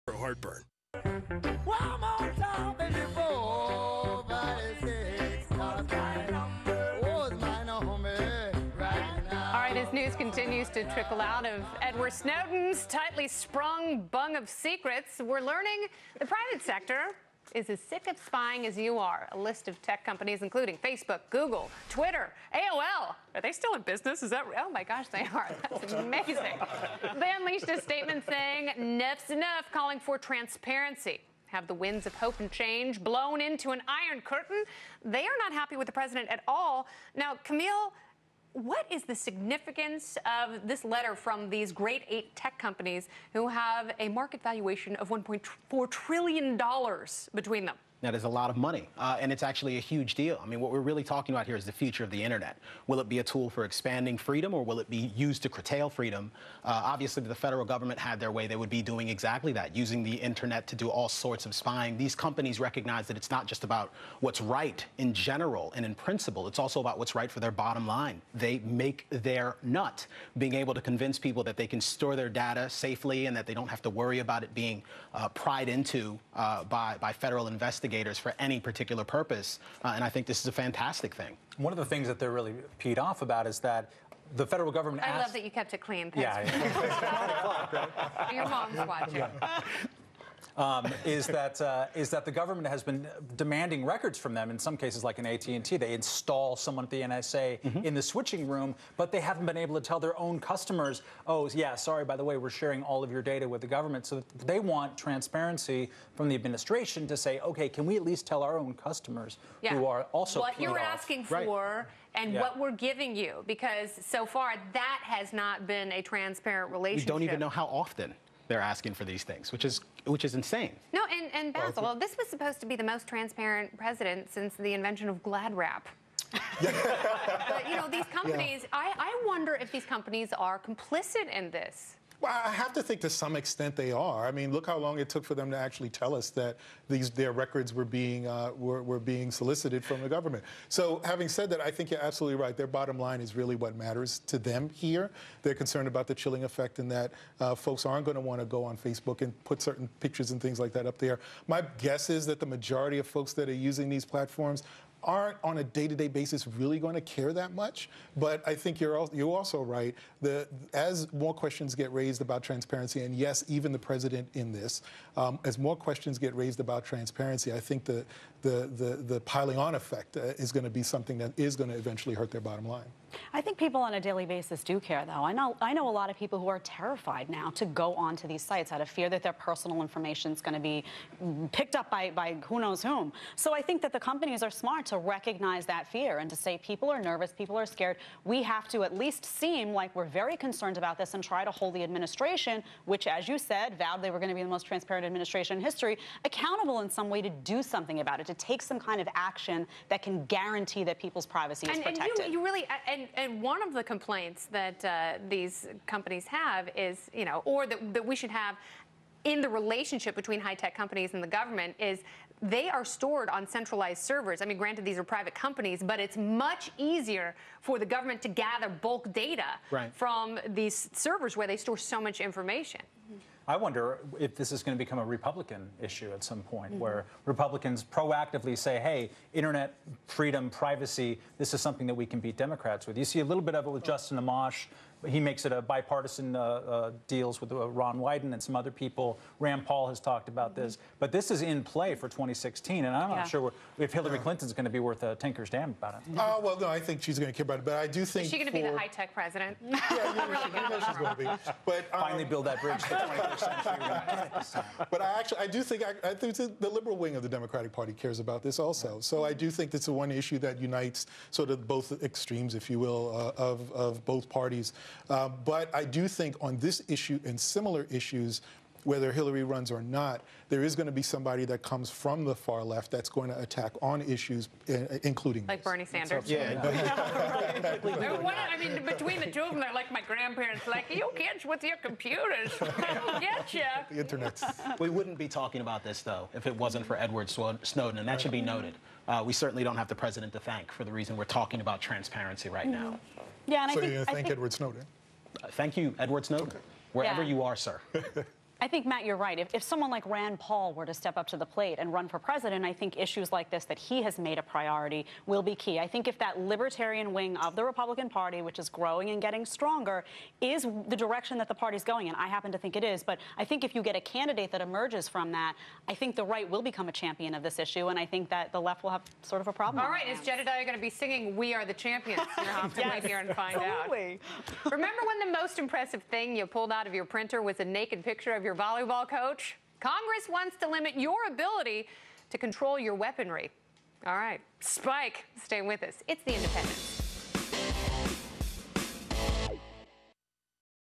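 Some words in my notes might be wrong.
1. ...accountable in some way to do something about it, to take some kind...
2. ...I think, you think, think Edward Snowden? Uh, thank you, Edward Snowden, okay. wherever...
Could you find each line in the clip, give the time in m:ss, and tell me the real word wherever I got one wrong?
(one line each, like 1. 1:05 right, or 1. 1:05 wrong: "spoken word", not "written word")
1. 3:16 right
2. 4:53 right.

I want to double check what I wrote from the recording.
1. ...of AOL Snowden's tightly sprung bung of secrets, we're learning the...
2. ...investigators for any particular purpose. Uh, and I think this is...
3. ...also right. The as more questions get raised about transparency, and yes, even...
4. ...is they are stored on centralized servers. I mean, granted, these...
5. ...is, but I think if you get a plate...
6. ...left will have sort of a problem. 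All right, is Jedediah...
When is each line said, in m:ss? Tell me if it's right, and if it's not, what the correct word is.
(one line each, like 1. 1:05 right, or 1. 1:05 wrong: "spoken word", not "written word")
1. 0:11 wrong: "Edward", not "AOL"
2. 1:17 right
3. 2:39 right
4. 3:31 right
5. 5:12 wrong: "candidate", not "plate"
6. 5:18 right.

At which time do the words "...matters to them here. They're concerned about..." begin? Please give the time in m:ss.
2:23.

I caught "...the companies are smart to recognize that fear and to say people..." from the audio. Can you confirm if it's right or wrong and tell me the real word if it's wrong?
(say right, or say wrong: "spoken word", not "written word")
right.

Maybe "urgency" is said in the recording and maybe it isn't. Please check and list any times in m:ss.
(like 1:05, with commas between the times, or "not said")
not said.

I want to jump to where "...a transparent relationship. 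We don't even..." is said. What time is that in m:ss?
1:55.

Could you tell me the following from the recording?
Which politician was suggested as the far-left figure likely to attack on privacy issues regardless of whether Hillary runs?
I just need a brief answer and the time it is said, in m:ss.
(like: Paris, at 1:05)
Bernie Sanders, at 4:35.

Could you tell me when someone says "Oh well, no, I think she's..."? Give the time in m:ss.
4:06.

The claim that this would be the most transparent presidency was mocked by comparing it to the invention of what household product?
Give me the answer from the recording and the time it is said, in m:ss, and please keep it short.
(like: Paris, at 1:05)
Glad Wrap, at 2:05.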